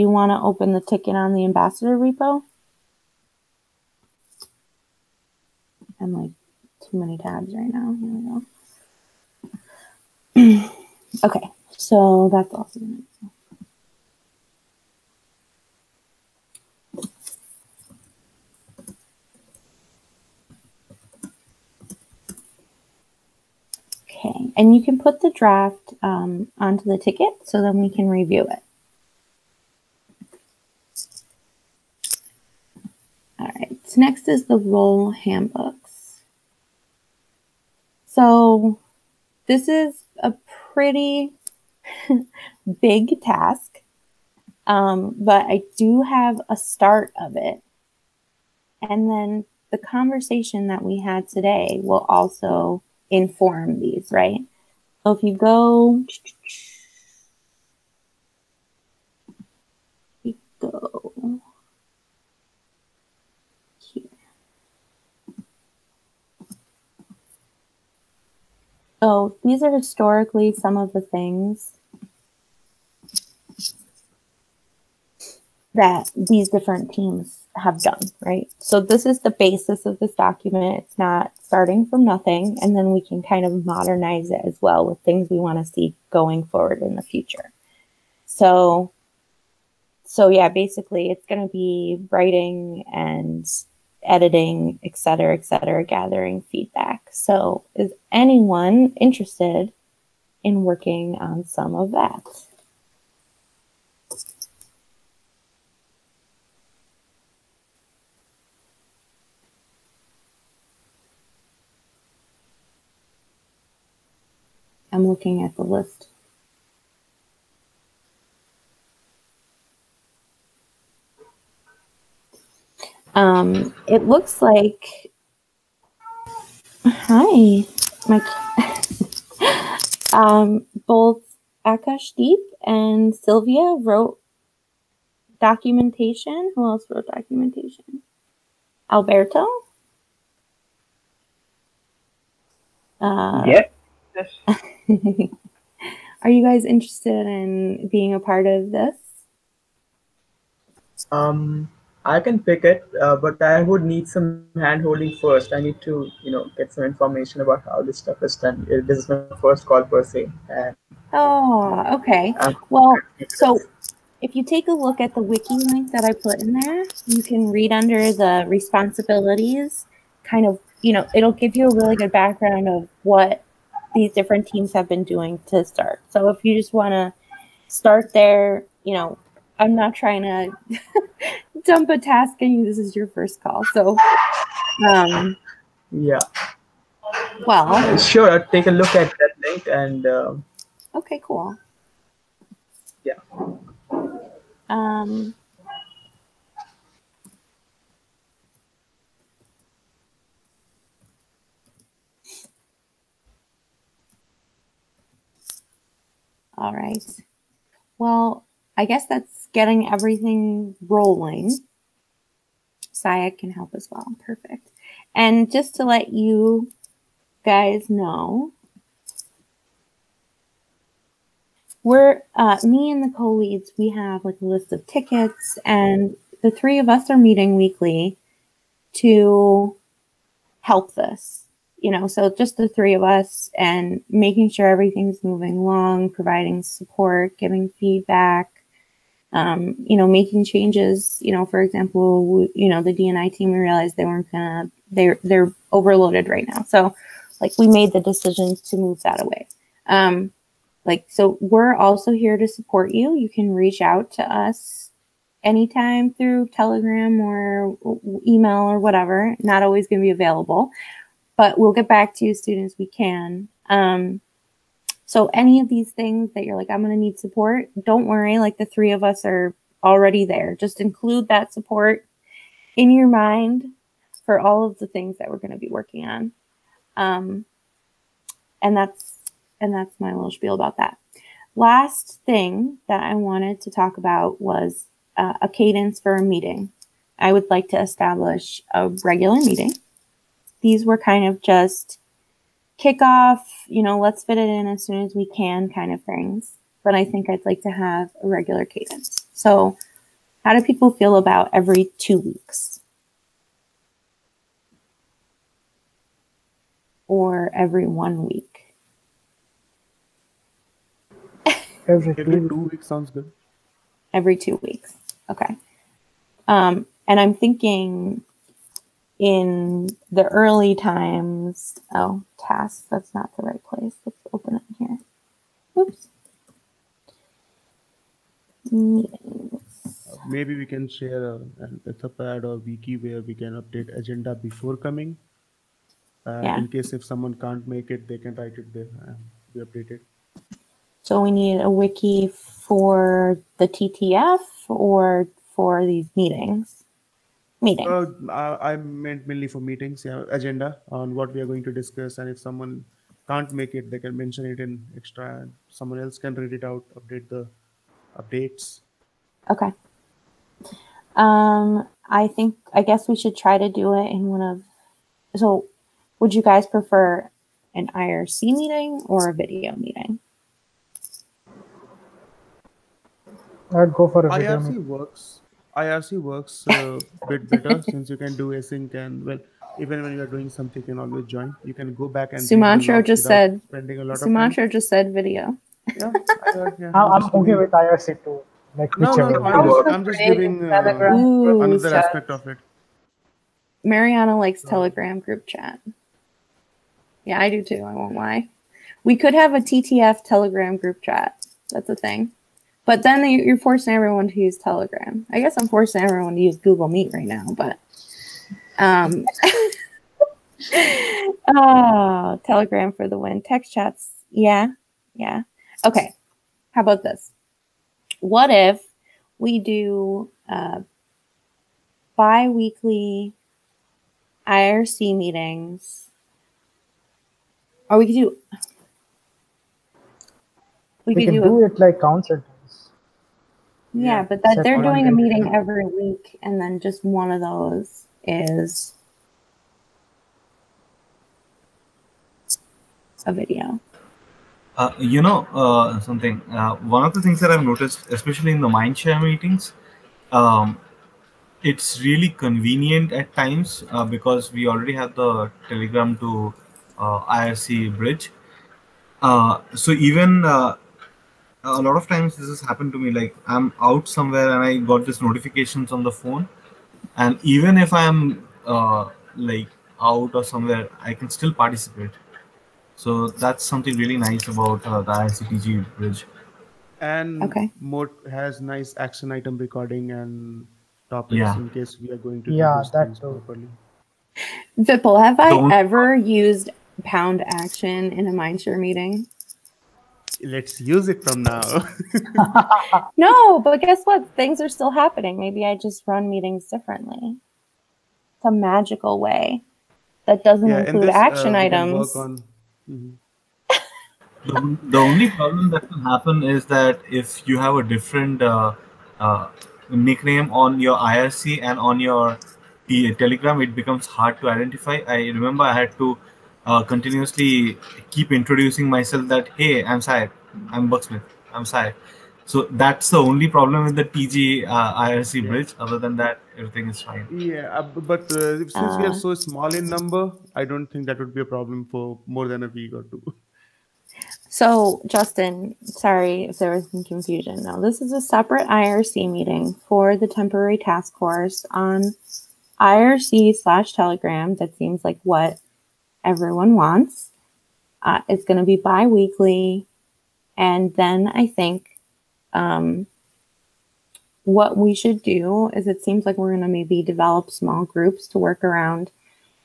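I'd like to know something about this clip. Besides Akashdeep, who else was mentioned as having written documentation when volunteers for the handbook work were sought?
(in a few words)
Sylvia.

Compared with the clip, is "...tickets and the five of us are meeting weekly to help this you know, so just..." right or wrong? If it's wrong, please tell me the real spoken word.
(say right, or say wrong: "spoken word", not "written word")
wrong: "three", not "five".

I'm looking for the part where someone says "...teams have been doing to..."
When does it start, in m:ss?
2:54.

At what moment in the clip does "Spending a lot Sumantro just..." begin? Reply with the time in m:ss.
6:23.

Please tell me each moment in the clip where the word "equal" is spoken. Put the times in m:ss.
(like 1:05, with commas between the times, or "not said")
not said.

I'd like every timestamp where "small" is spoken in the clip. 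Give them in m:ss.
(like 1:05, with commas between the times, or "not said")
8:49, 9:17.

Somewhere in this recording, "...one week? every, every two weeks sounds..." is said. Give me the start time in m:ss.
5:07.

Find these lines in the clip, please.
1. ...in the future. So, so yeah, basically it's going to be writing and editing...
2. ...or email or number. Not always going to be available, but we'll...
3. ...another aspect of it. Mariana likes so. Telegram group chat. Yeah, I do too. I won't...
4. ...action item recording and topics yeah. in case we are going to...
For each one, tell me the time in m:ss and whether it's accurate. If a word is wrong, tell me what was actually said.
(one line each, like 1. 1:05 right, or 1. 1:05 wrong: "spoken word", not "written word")
1. 1:26 right
2. 4:17 wrong: "whatever", not "number"
3. 6:31 right
4. 7:58 right.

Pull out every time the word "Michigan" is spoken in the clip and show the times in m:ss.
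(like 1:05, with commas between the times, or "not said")
not said.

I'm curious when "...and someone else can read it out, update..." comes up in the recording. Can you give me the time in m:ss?
5:55.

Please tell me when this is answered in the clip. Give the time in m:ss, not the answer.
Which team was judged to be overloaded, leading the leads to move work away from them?
4:02.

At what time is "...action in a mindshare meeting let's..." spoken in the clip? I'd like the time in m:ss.
8:07.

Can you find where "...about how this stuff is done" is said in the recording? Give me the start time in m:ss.
2:37.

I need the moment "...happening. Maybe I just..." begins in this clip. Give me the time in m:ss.
8:14.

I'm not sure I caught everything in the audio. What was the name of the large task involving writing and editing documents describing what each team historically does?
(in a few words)
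Role handbooks.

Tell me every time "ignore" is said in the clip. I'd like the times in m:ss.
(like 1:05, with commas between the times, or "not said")
not said.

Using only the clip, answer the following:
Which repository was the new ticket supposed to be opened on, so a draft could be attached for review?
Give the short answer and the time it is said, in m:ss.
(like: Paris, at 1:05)
Ambassador repo, at 0:01.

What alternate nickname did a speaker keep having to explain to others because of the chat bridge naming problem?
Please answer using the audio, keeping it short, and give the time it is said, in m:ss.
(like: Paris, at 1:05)
Bucksmith, at 8:40.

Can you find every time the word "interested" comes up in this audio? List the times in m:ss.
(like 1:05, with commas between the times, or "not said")
1:39, 2:26.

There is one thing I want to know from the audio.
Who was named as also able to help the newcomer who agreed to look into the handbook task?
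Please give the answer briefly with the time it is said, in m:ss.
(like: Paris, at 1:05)
Sayak, at 3:32.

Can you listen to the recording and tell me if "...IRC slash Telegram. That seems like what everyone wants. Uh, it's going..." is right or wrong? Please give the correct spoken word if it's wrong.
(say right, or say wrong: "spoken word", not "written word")
right.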